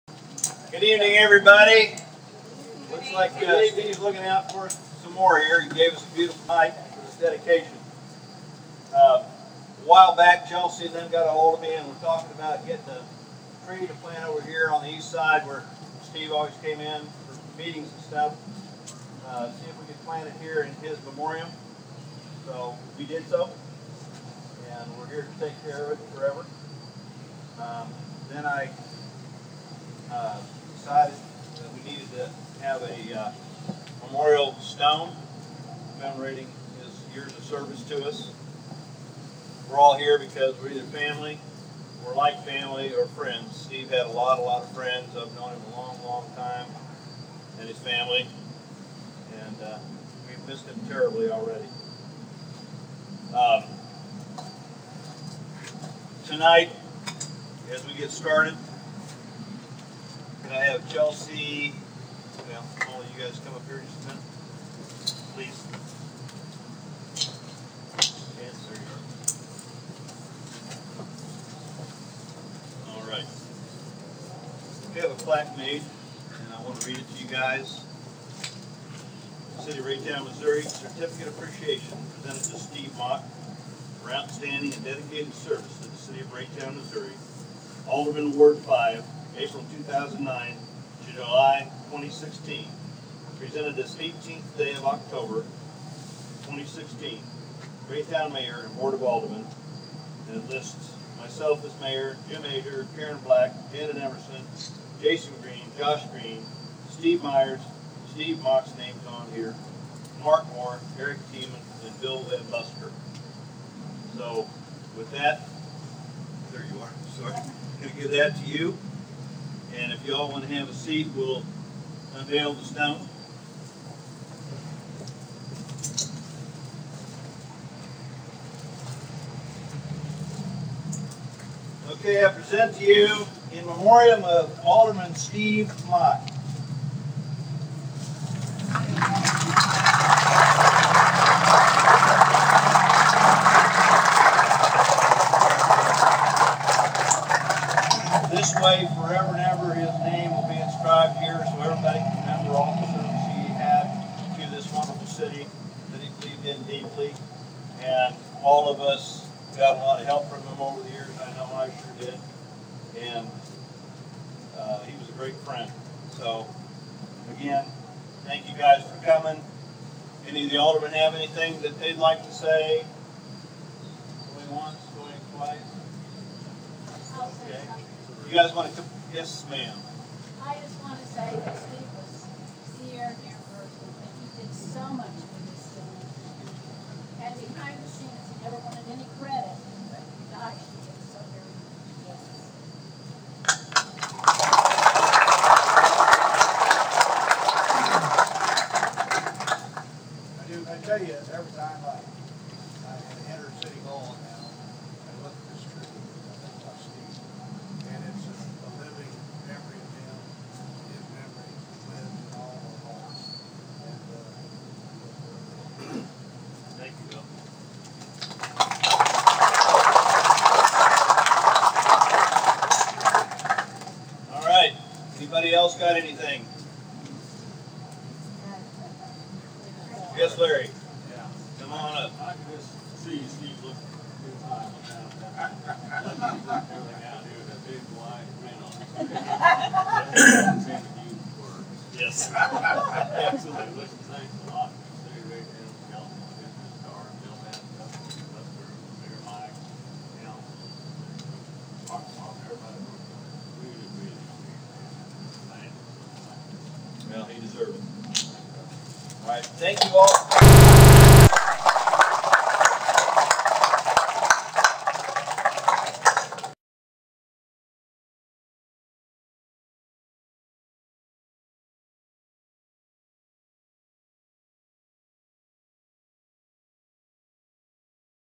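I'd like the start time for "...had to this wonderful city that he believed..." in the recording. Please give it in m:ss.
2:33.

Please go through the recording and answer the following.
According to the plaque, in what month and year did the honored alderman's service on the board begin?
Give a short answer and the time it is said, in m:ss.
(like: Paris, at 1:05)
April 2009, at 1:29.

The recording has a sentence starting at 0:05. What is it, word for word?
He gave us a beautiful night for this dedication.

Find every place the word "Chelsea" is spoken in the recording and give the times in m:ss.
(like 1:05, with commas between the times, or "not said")
0:10, 1:00.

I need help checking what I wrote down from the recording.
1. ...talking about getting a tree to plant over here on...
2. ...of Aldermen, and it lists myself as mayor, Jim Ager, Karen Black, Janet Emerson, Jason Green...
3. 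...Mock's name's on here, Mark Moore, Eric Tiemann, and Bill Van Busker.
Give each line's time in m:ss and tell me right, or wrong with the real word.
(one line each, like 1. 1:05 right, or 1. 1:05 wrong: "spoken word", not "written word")
1. 0:11 right
2. 1:38 right
3. 1:48 right.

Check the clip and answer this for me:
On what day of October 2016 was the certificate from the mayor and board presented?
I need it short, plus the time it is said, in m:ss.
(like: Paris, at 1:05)
18th, at 1:33.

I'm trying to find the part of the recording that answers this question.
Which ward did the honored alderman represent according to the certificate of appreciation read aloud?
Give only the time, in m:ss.
1:28.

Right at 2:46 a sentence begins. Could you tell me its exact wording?
So, again, thank you guys for coming.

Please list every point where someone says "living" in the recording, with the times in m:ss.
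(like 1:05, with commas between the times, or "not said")
3:28.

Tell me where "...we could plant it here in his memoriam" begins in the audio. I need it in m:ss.
0:19.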